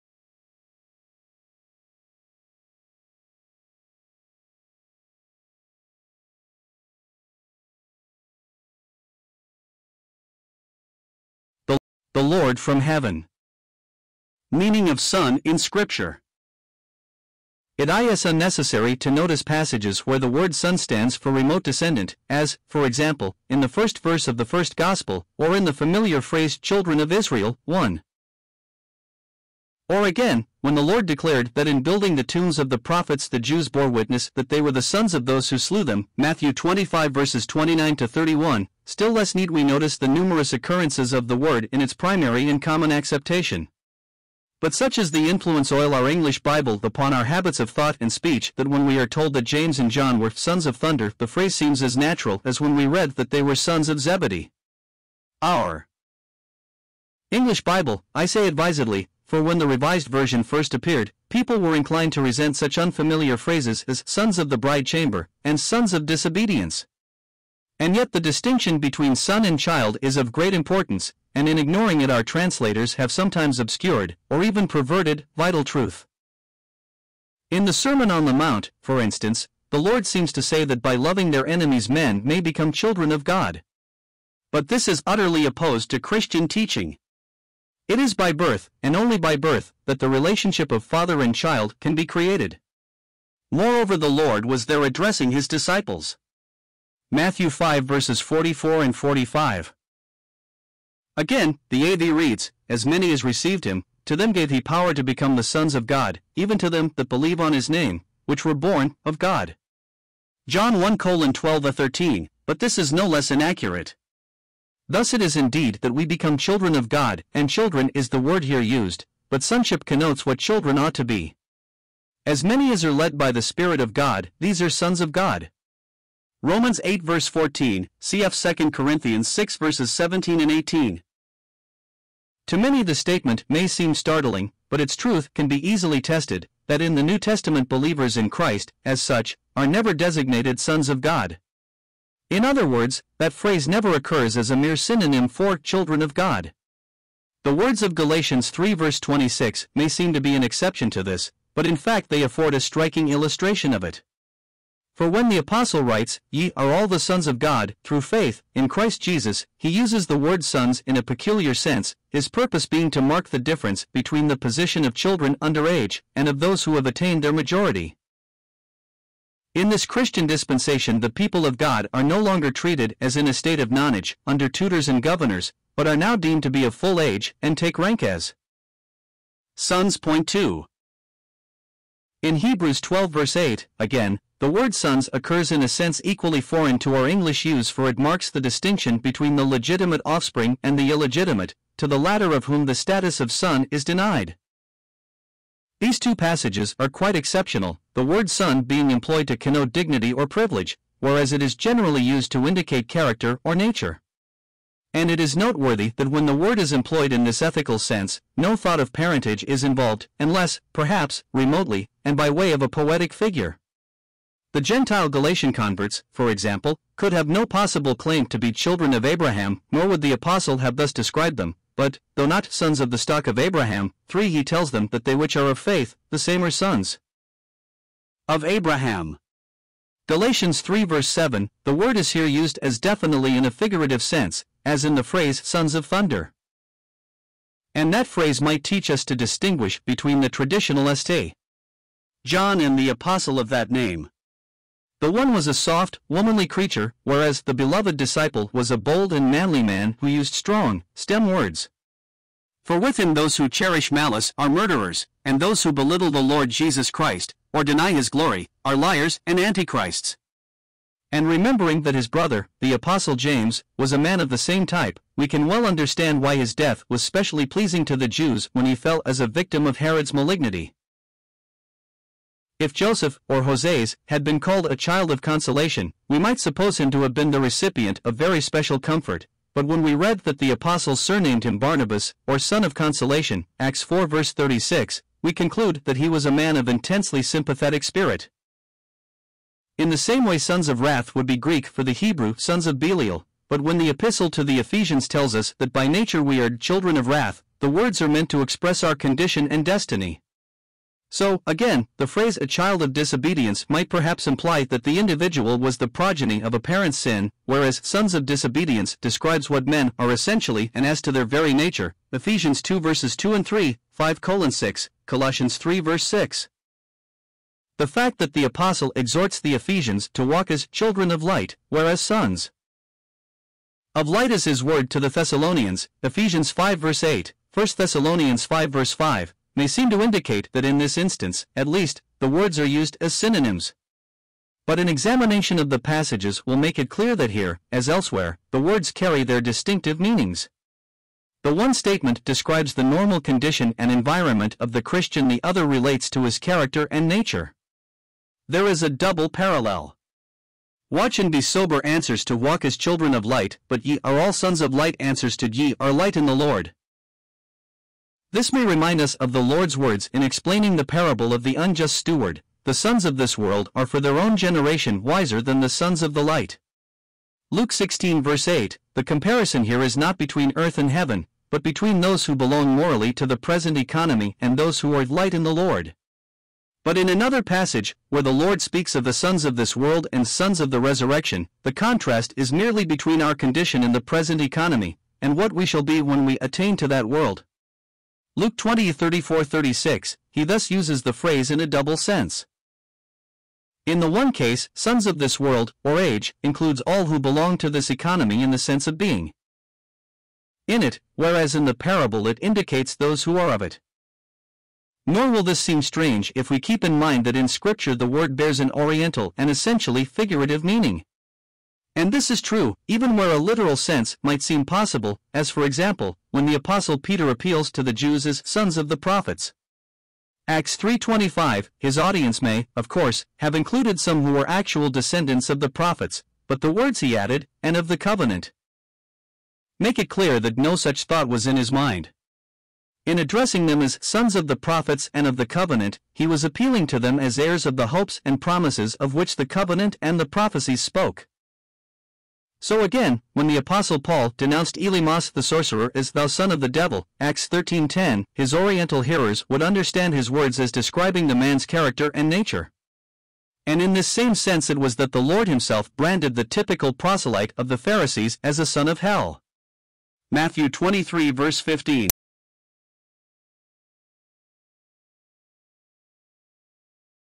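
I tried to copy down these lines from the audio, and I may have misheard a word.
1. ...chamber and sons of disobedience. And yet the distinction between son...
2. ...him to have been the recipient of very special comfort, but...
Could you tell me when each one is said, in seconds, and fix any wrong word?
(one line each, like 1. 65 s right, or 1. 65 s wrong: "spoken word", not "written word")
1. 64 s right
2. 276 s right.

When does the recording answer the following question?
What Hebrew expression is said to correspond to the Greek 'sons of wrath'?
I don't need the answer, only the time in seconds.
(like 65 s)
292 s.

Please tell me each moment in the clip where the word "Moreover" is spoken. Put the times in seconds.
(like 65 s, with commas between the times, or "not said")
93 s.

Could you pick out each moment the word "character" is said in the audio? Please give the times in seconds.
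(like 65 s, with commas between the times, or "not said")
202 s, 346 s, 451 s.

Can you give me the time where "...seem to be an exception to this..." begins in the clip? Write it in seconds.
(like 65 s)
149 s.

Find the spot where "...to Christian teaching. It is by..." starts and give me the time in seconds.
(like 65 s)
85 s.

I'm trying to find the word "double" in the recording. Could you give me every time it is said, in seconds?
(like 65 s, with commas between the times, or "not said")
348 s, 391 s.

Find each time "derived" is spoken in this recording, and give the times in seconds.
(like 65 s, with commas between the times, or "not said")
not said.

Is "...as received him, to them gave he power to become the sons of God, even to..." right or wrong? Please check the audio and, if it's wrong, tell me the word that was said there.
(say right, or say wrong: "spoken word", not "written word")
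right.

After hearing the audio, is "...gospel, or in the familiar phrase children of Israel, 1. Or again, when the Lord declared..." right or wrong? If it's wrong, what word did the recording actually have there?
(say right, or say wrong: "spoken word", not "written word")
right.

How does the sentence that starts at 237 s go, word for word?
And that phrase might teach us to distinguish between the traditional st.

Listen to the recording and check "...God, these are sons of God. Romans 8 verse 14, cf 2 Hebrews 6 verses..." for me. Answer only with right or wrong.
wrong.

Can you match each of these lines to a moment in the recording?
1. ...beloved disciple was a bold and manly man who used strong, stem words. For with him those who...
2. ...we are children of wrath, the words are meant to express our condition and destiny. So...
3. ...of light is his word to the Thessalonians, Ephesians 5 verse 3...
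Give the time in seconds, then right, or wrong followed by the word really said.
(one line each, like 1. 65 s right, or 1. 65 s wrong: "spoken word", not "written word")
1. 247 s right
2. 296 s right
3. 323 s wrong: "8", not "3".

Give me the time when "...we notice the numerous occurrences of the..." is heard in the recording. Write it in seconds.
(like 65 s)
39 s.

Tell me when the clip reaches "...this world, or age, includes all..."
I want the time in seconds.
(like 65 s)
395 s.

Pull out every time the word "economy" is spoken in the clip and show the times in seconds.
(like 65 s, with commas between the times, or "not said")
373 s, 384 s, 397 s.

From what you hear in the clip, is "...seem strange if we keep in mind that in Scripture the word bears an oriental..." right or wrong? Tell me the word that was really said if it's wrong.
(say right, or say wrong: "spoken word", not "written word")
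right.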